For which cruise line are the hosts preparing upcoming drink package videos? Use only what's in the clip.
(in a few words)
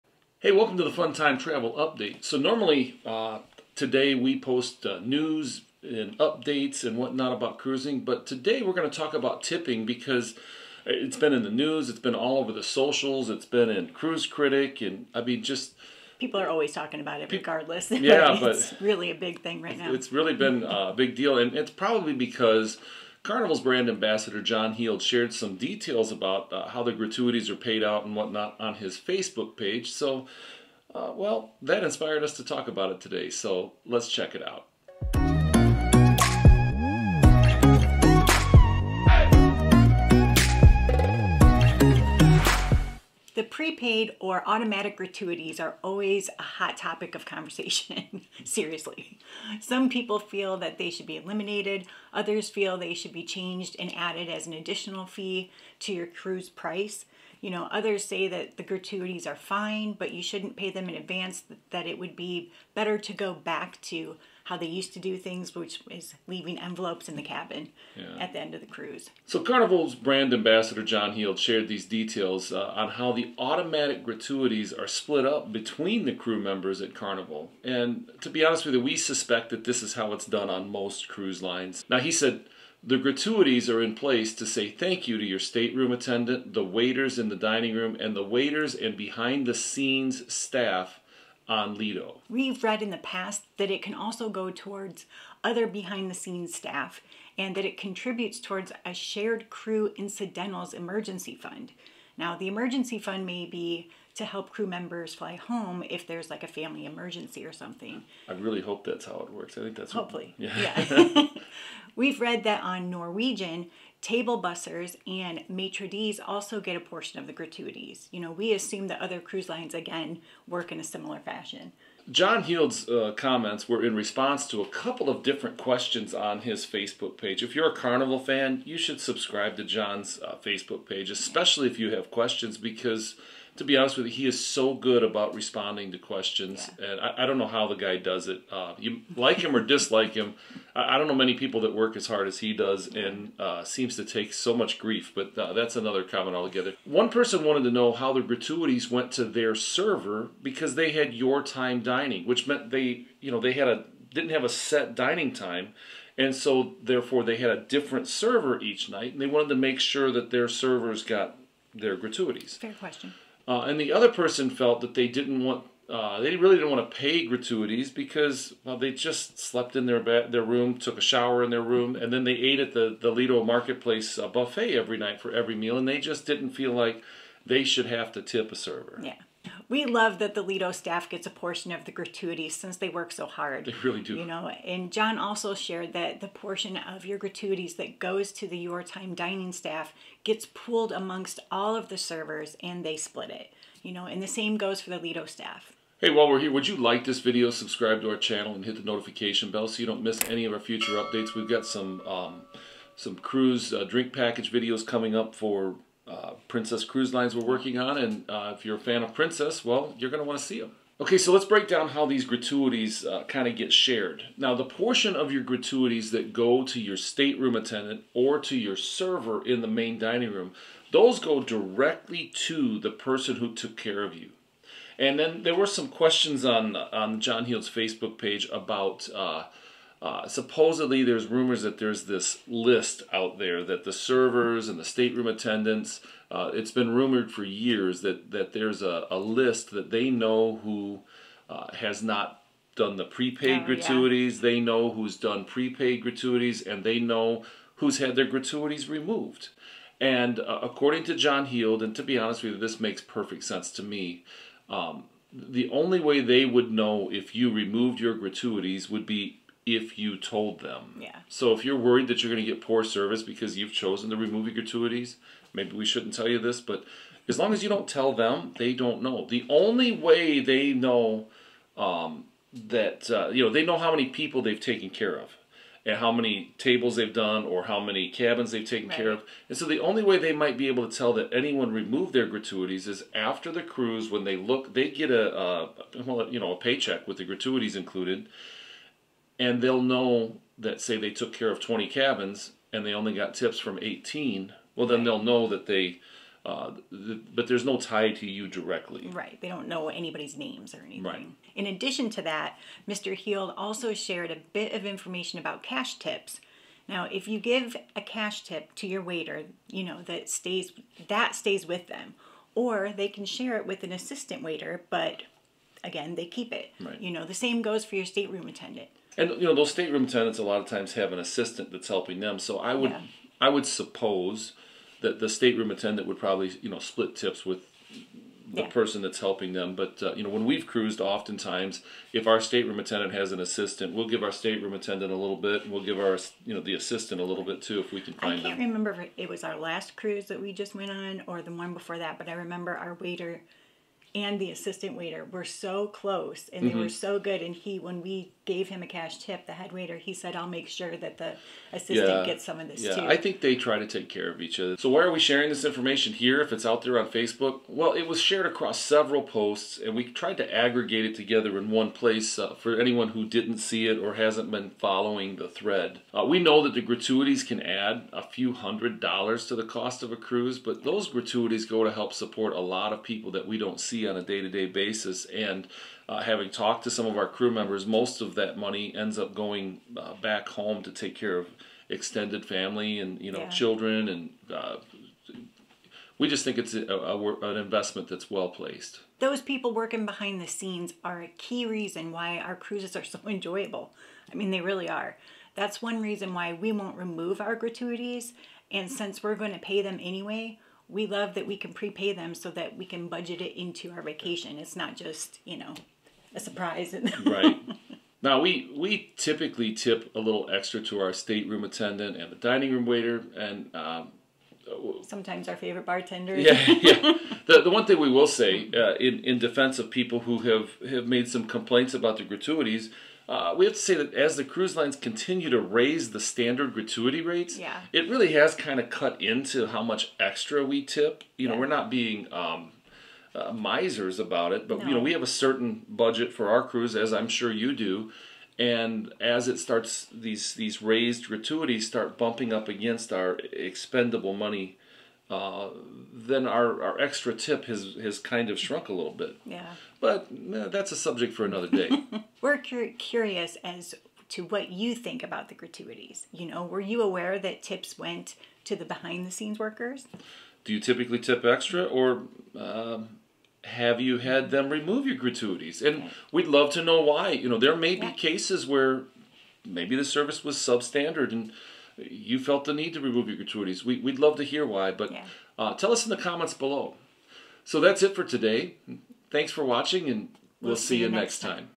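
Princess Cruise Lines.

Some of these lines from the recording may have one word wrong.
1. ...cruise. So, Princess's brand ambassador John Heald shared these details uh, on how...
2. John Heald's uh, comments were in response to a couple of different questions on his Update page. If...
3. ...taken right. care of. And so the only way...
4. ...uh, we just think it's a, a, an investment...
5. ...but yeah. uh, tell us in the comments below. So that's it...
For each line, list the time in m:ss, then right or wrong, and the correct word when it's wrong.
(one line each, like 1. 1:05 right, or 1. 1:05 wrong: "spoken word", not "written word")
1. 1:08 wrong: "Carnival", not "Princess"
2. 2:02 wrong: "Facebook", not "Update"
3. 4:38 right
4. 6:24 right
5. 7:54 right.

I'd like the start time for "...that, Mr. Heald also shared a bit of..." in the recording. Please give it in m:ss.
5:02.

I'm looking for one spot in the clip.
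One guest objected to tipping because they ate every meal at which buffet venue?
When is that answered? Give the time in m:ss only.
2:53.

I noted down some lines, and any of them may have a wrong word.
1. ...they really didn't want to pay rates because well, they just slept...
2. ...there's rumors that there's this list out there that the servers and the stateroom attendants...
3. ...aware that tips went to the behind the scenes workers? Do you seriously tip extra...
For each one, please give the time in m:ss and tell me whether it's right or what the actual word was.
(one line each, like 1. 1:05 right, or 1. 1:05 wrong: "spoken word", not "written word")
1. 2:46 wrong: "gratuities", not "rates"
2. 3:51 right
3. 7:37 wrong: "typically", not "seriously".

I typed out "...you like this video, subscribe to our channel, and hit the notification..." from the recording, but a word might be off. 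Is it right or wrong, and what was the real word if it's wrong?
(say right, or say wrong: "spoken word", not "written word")
right.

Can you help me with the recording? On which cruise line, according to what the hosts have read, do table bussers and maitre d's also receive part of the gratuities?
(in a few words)
Norwegian.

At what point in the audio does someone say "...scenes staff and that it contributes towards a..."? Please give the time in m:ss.
1:36.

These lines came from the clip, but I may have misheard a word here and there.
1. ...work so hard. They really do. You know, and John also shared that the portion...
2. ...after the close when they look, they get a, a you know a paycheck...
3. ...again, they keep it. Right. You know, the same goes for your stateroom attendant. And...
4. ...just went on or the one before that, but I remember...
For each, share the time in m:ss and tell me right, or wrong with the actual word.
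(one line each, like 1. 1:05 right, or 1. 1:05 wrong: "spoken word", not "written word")
1. 3:02 right
2. 4:43 wrong: "cruise", not "close"
3. 5:15 right
4. 5:40 right.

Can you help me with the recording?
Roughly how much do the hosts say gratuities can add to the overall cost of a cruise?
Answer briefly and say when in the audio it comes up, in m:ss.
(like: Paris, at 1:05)
a few hundred dollars, at 6:08.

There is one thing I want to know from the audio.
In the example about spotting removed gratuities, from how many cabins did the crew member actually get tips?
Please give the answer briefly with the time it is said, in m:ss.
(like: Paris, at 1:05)
18, at 4:53.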